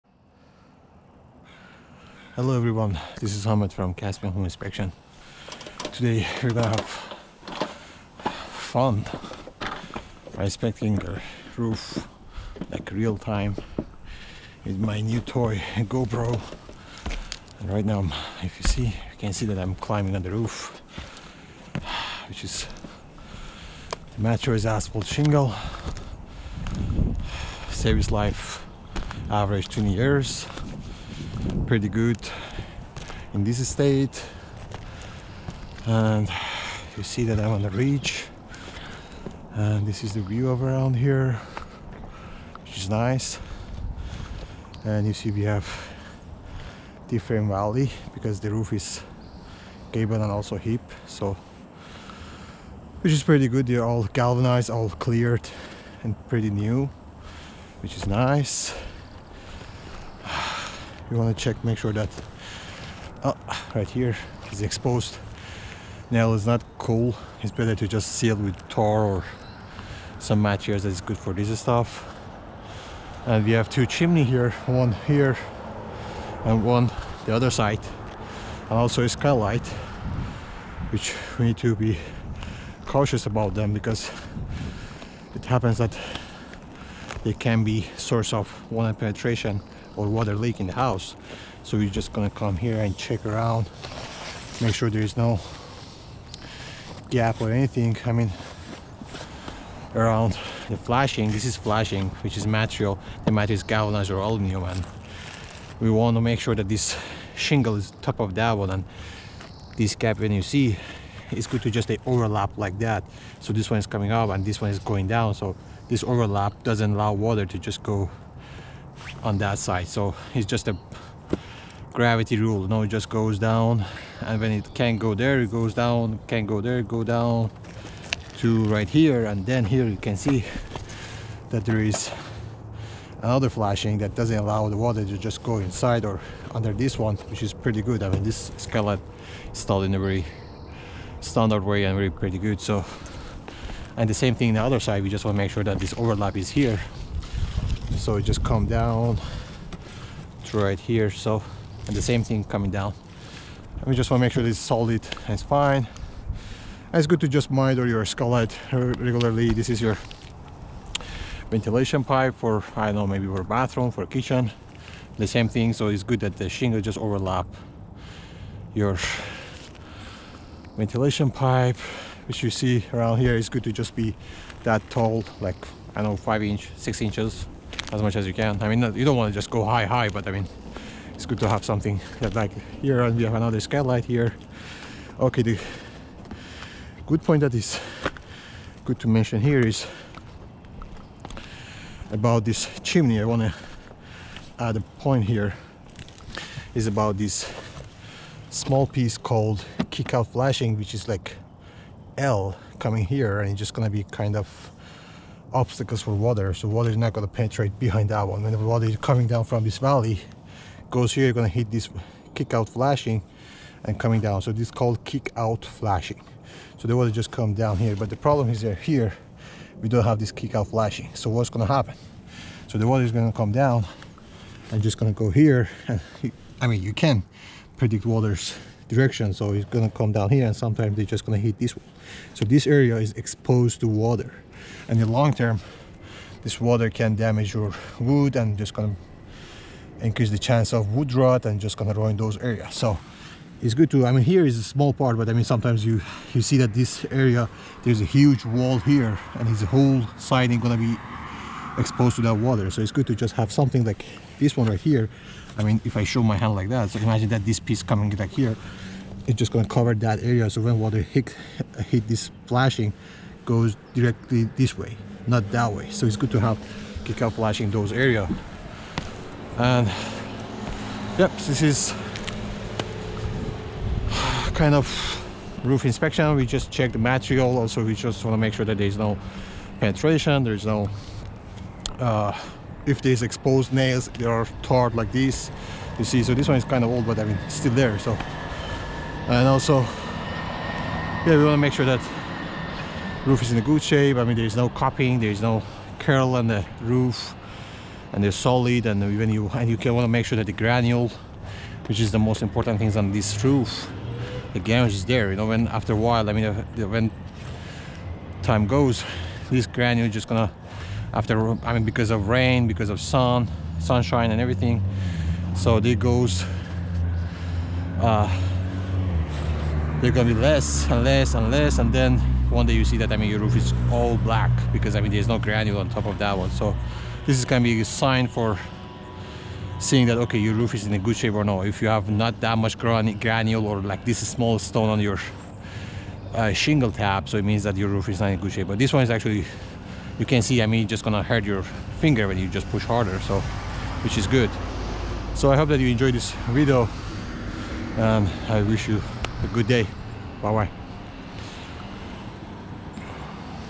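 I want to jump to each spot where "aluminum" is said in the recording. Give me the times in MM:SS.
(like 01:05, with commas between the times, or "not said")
01:44.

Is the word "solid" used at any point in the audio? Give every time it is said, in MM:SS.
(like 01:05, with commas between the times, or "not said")
02:34, 04:58.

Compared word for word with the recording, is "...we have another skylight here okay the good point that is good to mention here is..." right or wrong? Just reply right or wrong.
right.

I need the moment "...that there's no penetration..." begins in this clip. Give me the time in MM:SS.
04:38.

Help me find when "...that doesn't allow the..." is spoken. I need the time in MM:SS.
02:13.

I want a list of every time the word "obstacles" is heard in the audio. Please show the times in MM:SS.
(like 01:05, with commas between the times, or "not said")
03:25.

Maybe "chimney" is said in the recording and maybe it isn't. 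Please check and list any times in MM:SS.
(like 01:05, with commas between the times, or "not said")
01:13, 03:12.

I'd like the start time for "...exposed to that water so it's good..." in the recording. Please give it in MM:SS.
04:11.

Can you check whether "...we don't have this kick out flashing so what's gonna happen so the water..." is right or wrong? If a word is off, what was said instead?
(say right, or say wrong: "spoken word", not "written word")
right.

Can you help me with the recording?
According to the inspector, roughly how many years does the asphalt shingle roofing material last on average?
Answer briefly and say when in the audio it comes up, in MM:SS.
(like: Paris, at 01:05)
20 years, at 00:29.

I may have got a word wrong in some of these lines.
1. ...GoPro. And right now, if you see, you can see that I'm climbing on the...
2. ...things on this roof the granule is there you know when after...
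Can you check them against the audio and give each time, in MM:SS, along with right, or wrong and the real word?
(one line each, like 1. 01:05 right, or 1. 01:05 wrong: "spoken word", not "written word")
1. 00:15 right
2. 05:02 right.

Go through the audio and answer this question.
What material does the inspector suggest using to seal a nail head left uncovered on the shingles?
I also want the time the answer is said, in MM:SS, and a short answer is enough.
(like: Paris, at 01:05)
tar, at 01:08.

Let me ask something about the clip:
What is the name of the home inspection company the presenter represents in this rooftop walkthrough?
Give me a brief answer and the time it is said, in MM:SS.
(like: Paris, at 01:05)
Caspian Home Inspection, at 00:03.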